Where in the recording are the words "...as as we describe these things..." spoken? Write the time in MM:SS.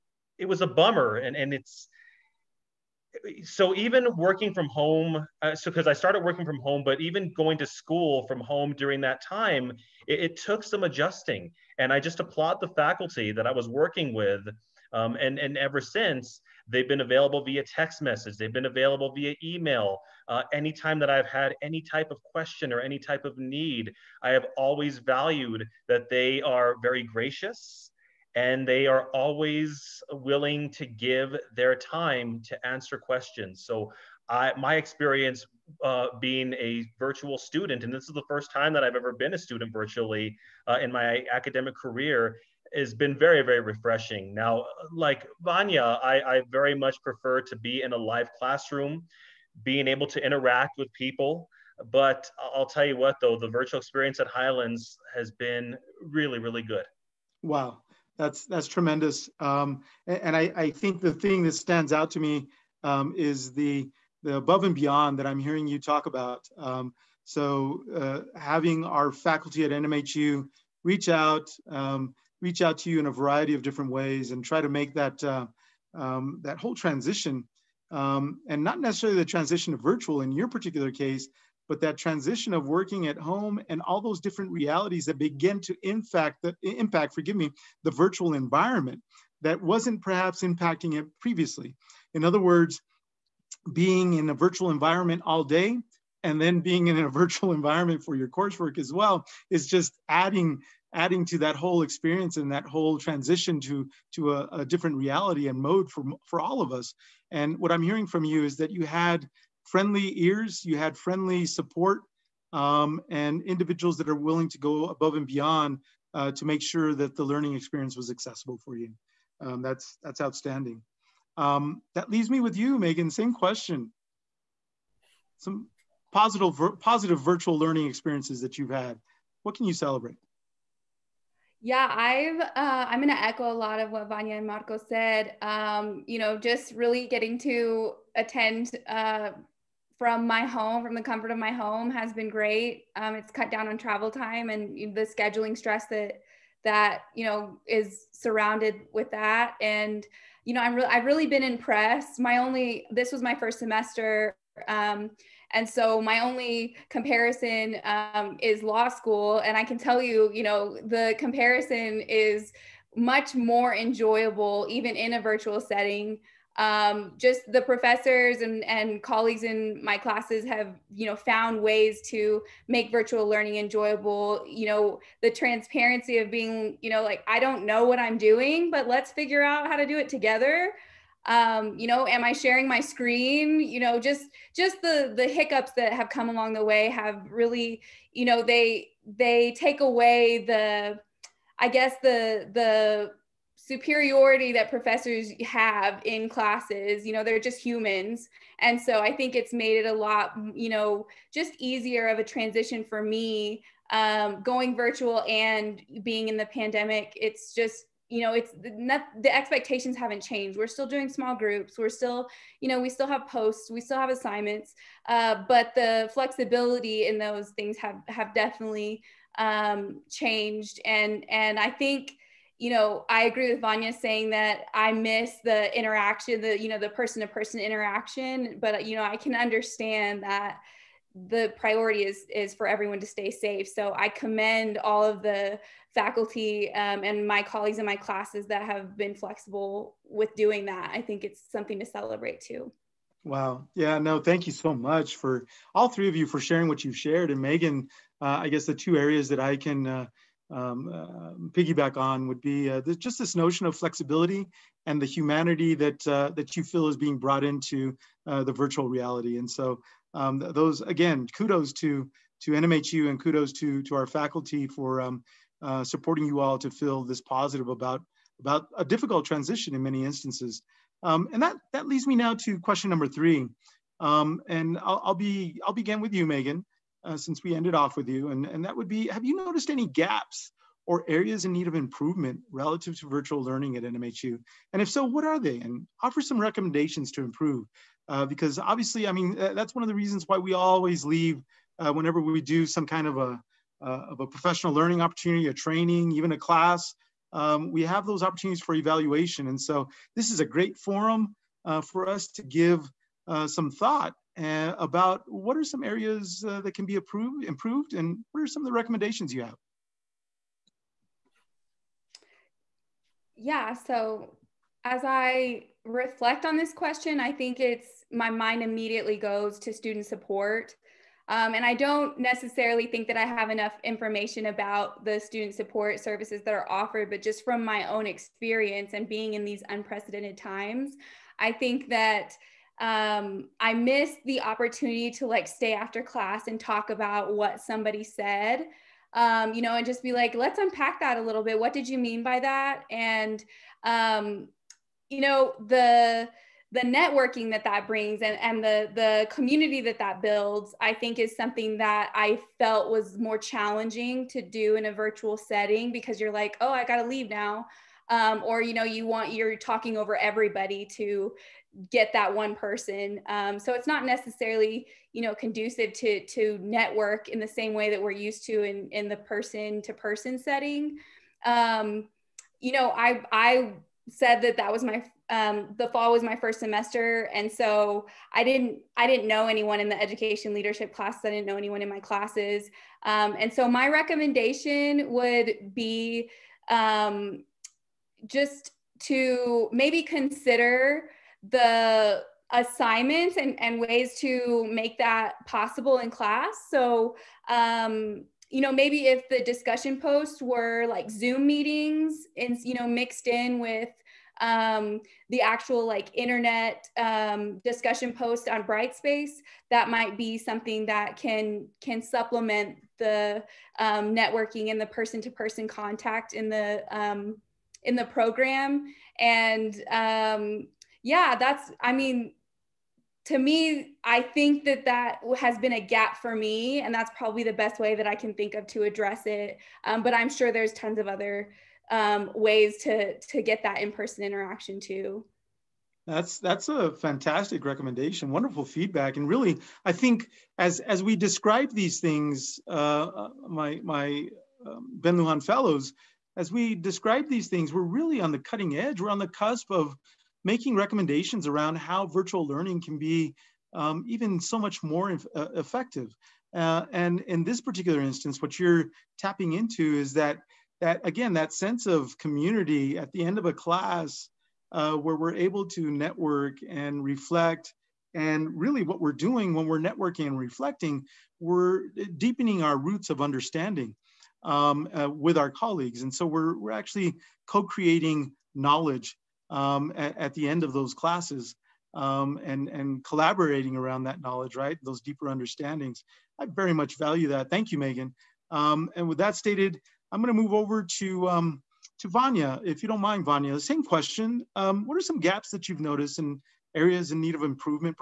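07:20.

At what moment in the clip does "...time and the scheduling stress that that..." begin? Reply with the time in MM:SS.
02:24.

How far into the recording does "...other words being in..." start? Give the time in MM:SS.
01:32.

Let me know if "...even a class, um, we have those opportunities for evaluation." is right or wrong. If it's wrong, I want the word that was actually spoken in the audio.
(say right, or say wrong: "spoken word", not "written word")
right.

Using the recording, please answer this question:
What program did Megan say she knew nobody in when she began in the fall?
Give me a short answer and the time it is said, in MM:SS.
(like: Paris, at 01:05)
education leadership, at 06:19.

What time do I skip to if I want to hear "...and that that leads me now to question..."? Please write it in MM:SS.
04:31.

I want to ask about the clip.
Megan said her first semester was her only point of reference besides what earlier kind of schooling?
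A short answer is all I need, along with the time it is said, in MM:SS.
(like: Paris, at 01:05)
law school, at 02:38.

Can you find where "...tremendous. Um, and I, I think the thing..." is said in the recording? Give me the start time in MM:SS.
00:58.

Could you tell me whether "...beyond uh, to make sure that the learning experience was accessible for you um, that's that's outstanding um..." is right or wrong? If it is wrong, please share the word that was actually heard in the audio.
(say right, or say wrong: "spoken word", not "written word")
right.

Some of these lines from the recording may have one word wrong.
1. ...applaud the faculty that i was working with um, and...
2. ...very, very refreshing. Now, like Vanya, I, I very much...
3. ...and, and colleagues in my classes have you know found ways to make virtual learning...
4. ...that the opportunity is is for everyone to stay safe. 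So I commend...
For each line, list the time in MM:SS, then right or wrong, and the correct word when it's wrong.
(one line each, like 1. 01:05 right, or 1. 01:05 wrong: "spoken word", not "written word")
1. 00:12 right
2. 00:43 right
3. 02:48 right
4. 03:50 wrong: "priority", not "opportunity".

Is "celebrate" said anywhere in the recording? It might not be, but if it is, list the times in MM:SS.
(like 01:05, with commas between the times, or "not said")
02:09, 04:01.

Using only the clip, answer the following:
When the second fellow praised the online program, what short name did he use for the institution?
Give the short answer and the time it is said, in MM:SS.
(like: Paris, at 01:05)
Highlands, at 00:54.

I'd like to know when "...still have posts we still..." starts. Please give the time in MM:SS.
03:32.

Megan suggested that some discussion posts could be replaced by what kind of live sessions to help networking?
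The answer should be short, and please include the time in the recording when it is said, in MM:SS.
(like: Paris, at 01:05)
Zoom meetings, at 06:41.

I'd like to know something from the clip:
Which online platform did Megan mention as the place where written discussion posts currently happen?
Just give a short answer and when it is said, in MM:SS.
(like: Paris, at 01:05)
Brightspace, at 06:48.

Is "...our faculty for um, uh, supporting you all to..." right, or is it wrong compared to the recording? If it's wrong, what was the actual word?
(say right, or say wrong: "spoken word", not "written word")
right.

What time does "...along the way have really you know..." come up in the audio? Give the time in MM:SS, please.
03:06.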